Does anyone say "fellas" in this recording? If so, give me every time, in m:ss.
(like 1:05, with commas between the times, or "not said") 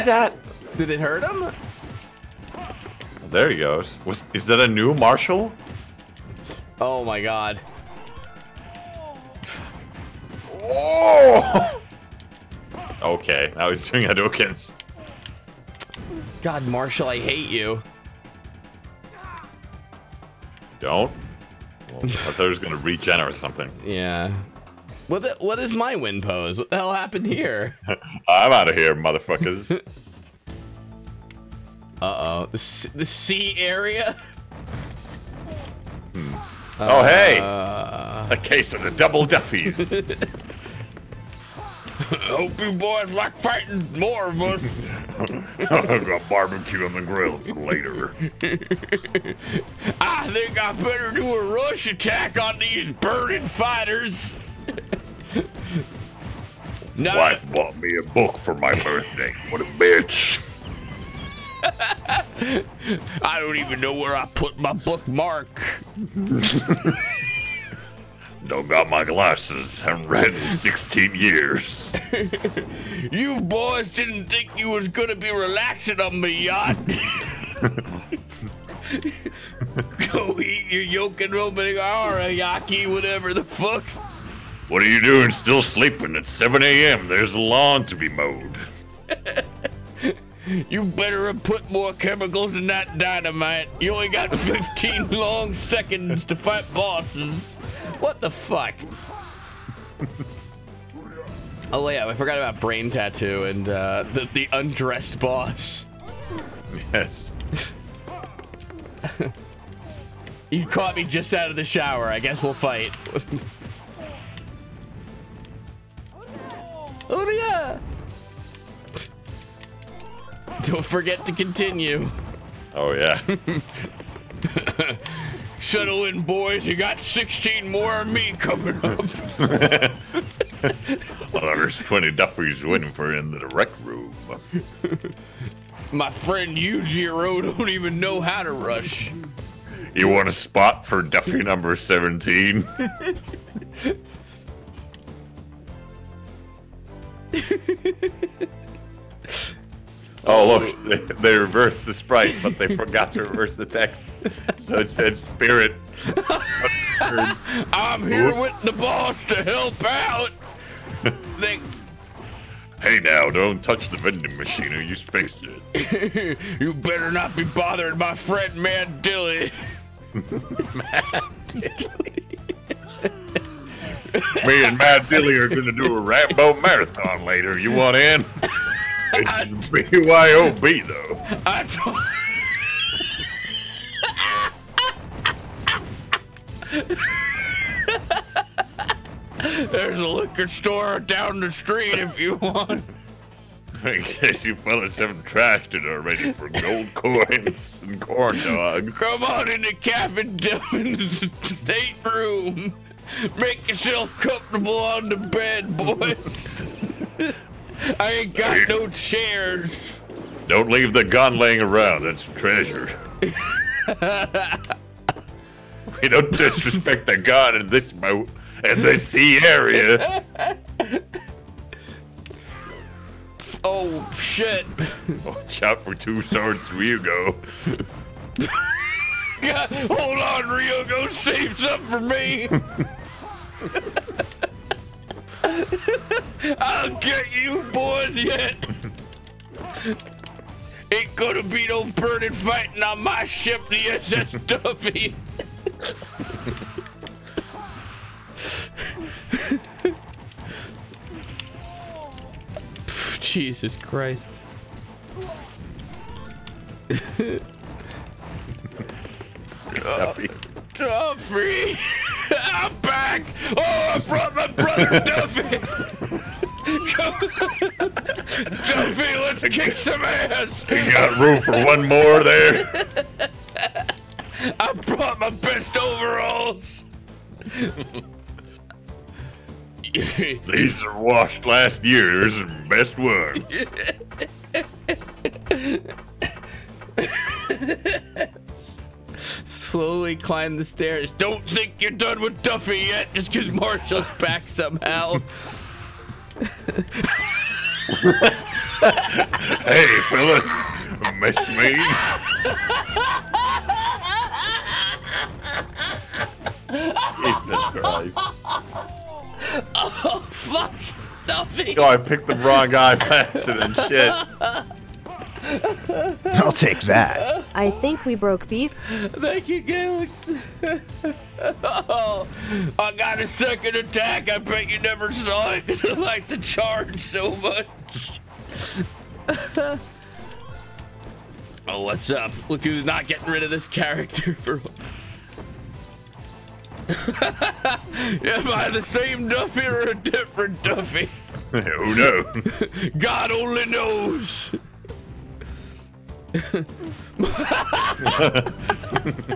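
3:14, 5:00.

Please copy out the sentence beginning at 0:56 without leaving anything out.
Now, Wife bought me a book for my birthday.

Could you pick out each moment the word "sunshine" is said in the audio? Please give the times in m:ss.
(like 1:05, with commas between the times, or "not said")
not said.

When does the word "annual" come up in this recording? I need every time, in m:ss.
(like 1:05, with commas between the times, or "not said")
not said.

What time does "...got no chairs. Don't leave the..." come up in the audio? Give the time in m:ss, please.
3:28.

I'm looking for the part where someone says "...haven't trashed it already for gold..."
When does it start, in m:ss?
3:14.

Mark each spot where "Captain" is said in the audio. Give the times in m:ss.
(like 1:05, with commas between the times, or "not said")
3:19.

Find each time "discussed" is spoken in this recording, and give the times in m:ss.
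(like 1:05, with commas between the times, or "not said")
not said.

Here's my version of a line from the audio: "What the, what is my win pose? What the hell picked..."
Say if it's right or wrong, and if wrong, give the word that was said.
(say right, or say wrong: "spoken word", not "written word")
wrong: "happened", not "picked".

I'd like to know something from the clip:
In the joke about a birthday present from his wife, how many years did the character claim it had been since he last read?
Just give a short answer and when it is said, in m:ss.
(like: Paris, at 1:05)
16, at 1:10.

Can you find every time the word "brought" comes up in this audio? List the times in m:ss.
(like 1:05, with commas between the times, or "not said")
4:24, 4:34.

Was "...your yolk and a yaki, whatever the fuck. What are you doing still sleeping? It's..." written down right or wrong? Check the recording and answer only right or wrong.
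right.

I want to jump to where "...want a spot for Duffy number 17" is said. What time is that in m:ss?
2:20.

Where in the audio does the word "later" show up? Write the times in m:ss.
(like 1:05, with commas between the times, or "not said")
0:47, 2:57.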